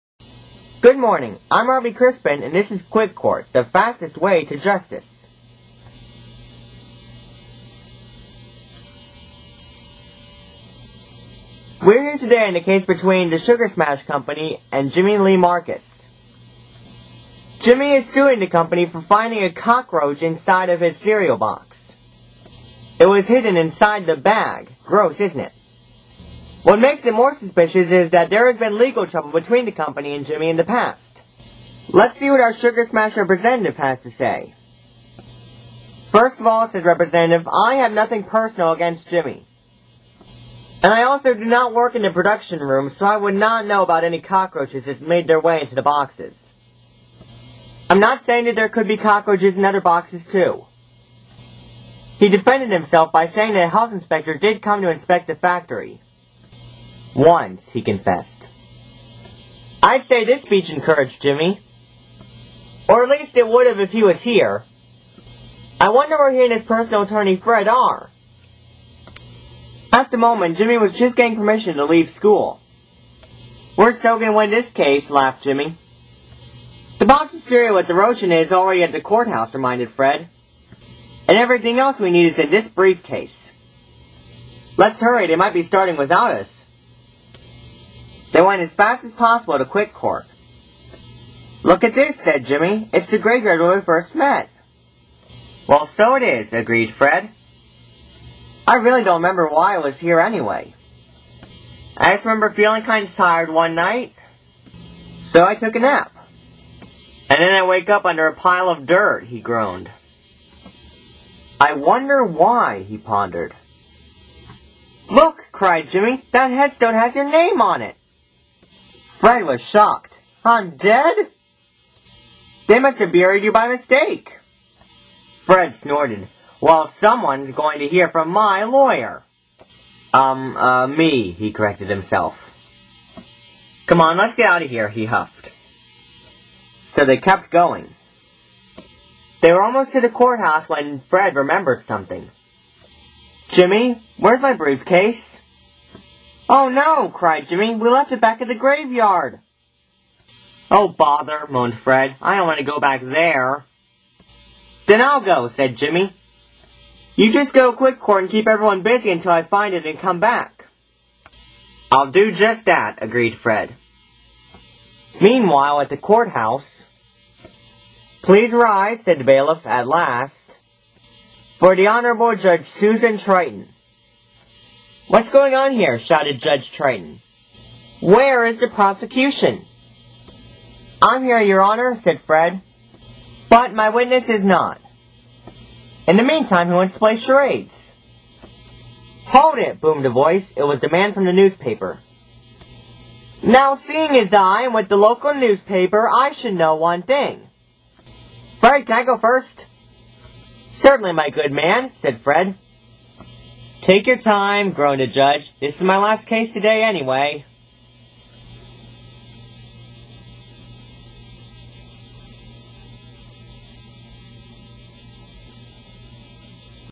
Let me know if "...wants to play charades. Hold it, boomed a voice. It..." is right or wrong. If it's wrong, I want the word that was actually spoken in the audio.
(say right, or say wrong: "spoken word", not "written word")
right.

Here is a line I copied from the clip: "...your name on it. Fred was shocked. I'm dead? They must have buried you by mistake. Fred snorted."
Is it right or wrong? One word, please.
right.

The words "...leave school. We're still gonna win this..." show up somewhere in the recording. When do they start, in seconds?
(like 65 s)
71 s.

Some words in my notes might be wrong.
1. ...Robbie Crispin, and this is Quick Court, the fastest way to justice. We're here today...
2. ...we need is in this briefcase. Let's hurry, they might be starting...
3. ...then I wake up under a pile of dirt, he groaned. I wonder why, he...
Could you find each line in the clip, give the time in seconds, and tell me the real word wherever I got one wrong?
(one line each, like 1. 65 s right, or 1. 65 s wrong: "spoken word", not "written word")
1. 1 s right
2. 81 s right
3. 107 s right.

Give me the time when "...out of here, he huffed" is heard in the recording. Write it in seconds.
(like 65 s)
134 s.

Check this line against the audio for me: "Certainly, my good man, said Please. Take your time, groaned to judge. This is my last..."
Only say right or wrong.
wrong.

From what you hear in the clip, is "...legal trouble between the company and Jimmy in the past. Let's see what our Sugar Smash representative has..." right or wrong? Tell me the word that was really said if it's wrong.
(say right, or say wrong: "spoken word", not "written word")
right.